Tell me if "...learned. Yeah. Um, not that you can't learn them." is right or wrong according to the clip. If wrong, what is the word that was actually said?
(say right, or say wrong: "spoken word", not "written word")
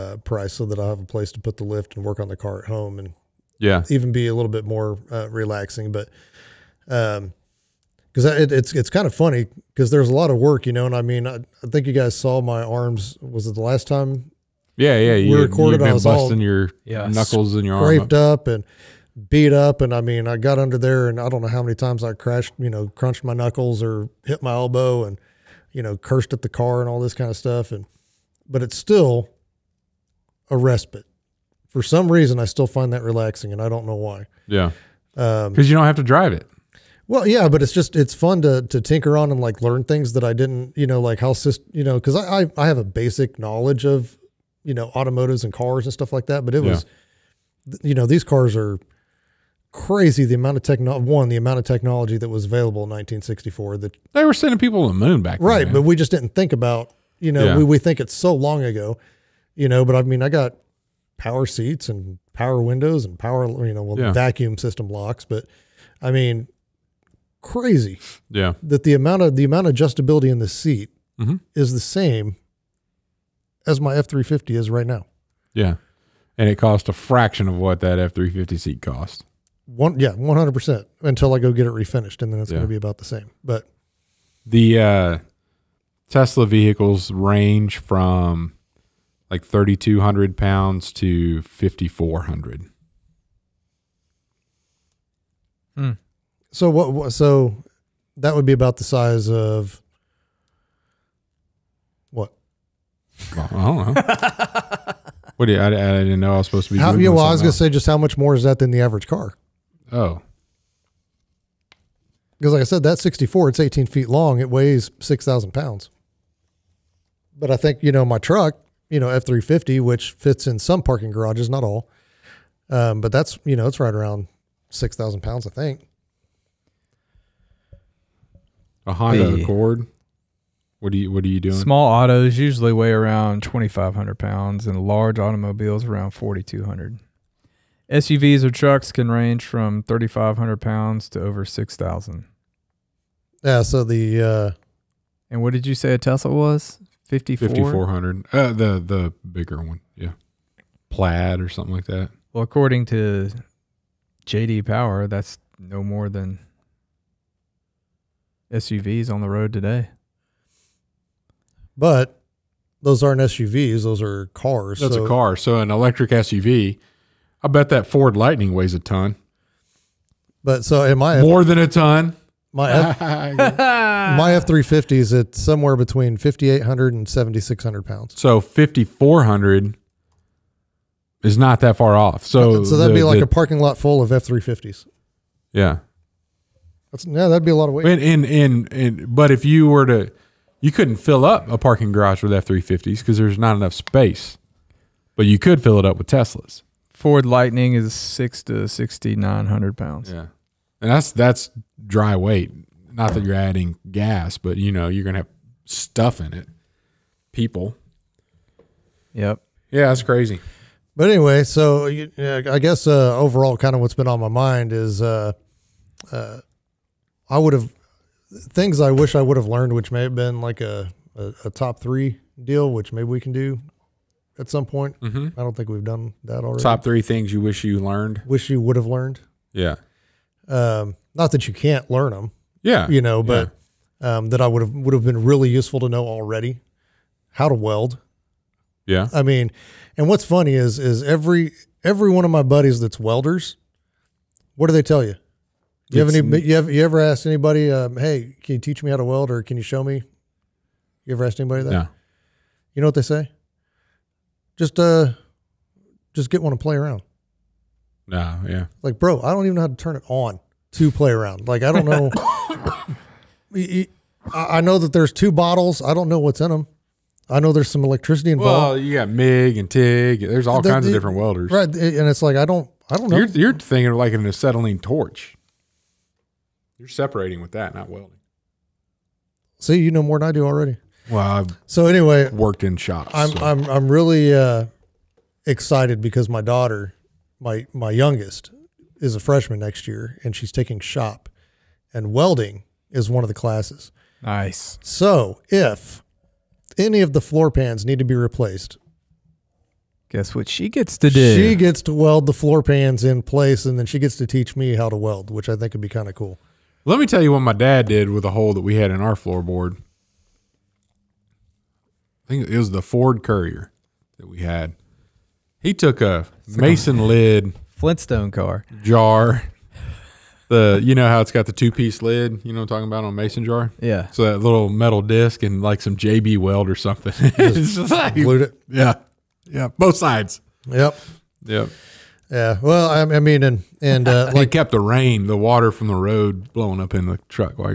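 right.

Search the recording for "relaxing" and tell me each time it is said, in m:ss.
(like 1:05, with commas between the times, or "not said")
0:05, 0:33.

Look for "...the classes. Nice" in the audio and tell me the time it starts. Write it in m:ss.
4:53.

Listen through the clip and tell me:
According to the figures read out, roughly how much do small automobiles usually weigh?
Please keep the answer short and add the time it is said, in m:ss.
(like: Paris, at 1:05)
2,500 pounds, at 2:13.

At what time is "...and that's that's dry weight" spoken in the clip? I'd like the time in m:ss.
3:20.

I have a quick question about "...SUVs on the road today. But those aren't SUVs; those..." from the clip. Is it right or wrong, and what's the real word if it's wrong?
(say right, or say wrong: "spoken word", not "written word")
right.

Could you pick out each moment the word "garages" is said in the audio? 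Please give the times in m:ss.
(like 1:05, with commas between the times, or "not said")
2:01, 3:11.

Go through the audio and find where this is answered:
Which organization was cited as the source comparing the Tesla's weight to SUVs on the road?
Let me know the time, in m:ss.
2:34.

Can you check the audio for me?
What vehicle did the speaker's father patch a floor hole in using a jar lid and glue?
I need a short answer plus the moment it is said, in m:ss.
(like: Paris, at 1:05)
Ford Courier, at 5:12.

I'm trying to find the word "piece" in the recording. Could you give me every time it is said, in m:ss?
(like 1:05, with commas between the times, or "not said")
5:21.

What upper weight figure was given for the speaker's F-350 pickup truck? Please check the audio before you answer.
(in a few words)
7,600 pounds.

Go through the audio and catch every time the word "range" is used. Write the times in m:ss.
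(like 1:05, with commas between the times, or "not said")
1:27, 2:19.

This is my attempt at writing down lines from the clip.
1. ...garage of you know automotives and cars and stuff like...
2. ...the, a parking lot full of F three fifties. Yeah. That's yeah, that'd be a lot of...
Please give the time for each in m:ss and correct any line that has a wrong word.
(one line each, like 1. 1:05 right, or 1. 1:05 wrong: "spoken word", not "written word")
1. 0:43 wrong: "knowledge", not "garage"
2. 3:03 right.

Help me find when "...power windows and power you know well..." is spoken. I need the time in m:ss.
1:02.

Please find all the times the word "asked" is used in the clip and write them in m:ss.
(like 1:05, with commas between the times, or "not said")
4:06, 4:11.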